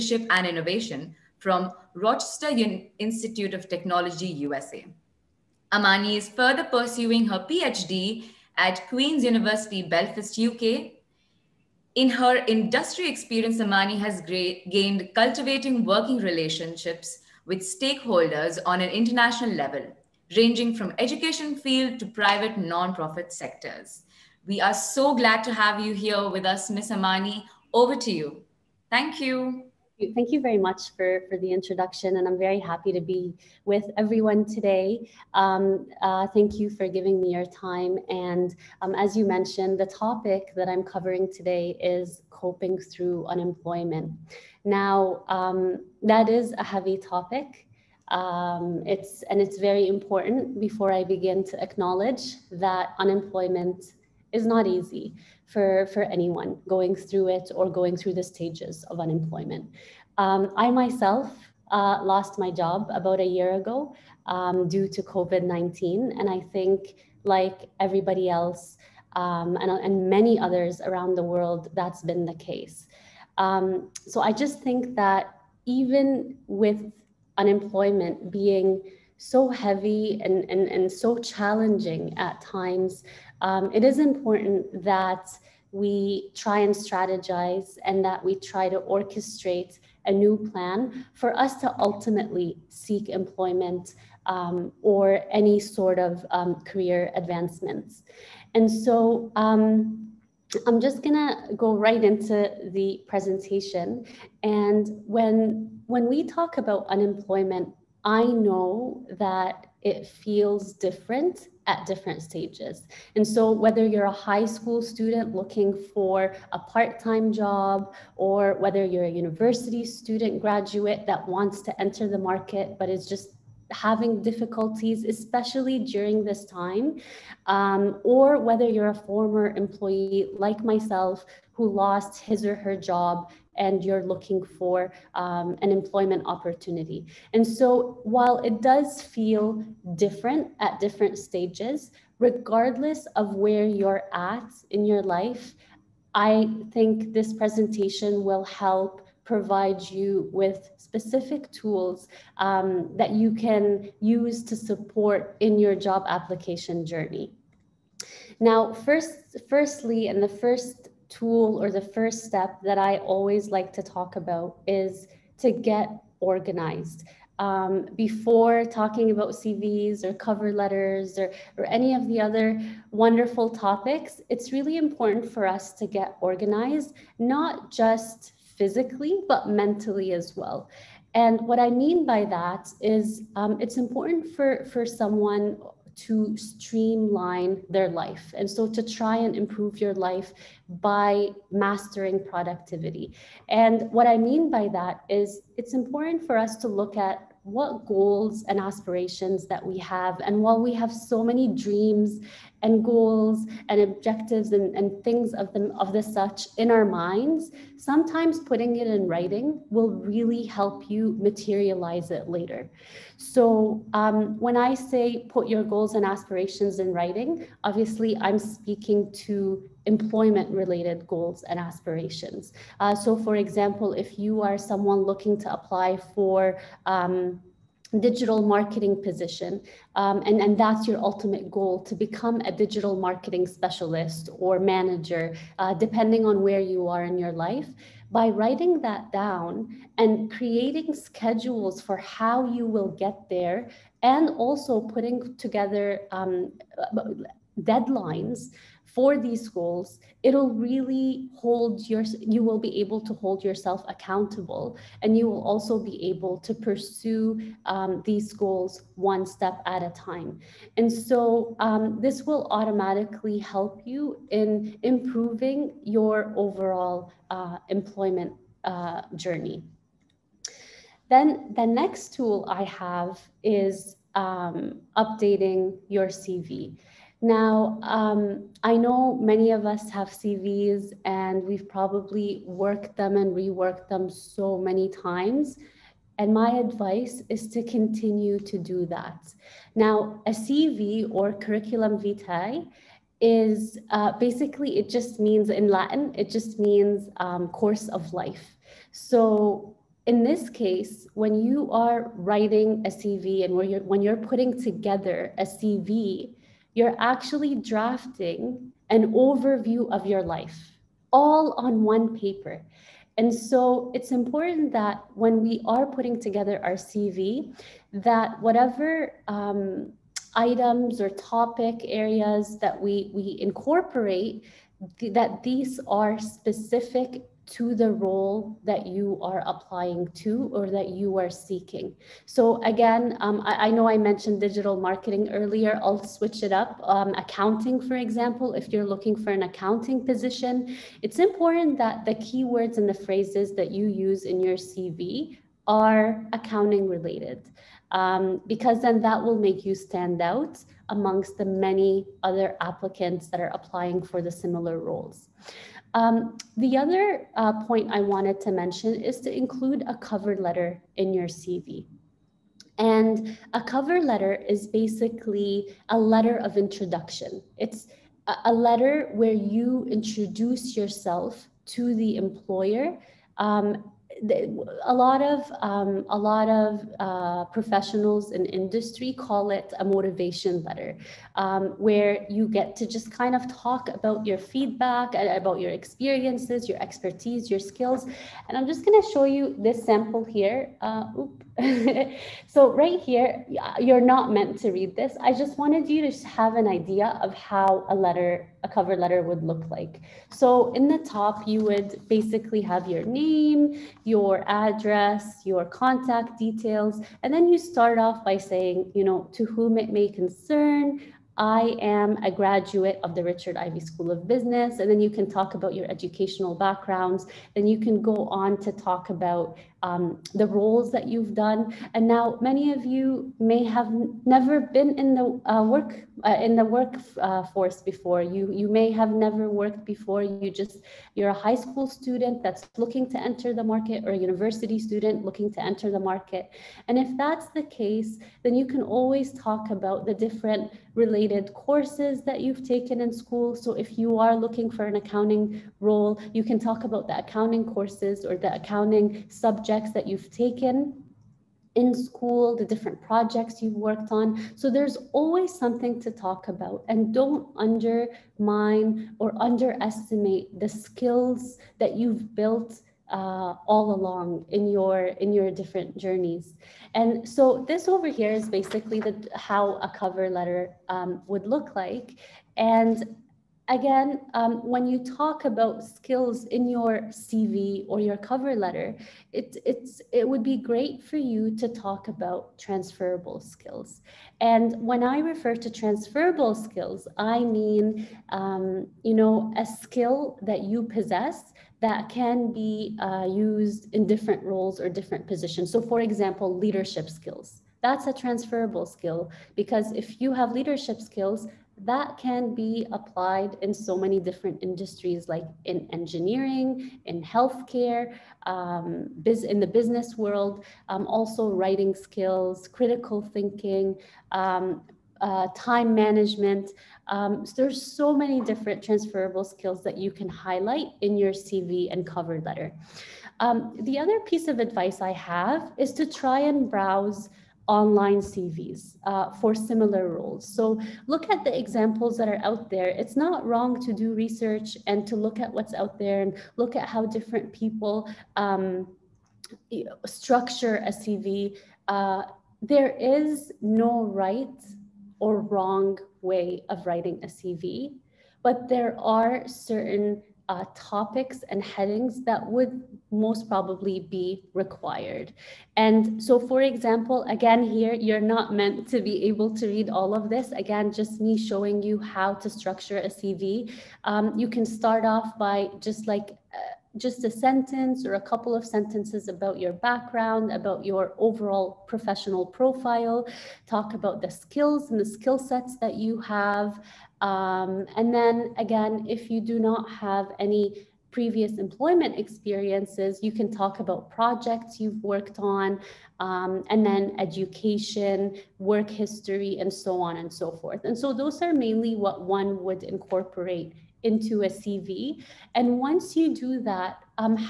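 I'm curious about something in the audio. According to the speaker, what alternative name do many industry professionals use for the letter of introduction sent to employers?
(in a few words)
motivation letter.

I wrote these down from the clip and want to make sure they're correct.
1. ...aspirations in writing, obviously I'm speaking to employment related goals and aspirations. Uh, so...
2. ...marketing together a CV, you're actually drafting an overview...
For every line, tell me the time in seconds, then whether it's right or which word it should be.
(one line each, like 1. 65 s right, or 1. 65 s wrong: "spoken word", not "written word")
1. 216 s right
2. 304 s wrong: "putting", not "marketing".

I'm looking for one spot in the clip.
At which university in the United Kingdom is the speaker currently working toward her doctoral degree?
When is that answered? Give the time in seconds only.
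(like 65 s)
8 s.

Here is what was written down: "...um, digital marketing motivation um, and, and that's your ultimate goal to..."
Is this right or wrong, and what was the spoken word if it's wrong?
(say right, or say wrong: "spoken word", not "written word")
wrong: "position", not "motivation".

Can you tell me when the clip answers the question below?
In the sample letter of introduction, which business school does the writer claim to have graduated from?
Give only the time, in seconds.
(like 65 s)
413 s.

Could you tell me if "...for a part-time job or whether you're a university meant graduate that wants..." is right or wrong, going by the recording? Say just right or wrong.
wrong.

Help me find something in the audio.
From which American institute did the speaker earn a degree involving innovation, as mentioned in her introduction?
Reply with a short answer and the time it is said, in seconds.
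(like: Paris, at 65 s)
Rochester Institute of Technology, at 1 s.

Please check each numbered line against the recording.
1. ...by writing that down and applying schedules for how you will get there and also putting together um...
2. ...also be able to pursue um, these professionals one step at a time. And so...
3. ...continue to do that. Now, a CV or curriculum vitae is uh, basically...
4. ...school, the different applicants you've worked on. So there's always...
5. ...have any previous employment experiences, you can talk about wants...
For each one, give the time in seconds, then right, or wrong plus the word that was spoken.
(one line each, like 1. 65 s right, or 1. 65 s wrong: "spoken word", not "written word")
1. 238 s wrong: "creating", not "applying"
2. 255 s wrong: "goals", not "professionals"
3. 287 s right
4. 451 s wrong: "projects", not "applicants"
5. 579 s wrong: "projects", not "wants".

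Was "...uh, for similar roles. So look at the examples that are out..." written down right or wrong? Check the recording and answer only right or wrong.
right.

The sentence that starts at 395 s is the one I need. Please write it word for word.
I just wanted you to have an idea of how a letter, a cover letter would look like.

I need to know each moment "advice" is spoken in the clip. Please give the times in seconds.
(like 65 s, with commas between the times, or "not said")
286 s, 524 s.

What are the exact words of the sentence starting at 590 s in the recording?
And so those are mainly what one would incorporate into a CV.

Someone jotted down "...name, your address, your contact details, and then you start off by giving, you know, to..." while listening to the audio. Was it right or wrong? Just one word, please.
wrong.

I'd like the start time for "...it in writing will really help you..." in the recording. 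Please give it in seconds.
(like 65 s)
208 s.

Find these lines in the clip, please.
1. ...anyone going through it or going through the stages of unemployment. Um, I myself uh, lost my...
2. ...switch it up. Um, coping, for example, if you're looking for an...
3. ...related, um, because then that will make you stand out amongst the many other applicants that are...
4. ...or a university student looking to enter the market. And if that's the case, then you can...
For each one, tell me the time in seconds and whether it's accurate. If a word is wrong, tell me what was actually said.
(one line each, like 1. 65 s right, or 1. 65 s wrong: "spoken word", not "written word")
1. 56 s right
2. 336 s wrong: "accounting", not "coping"
3. 346 s right
4. 434 s right.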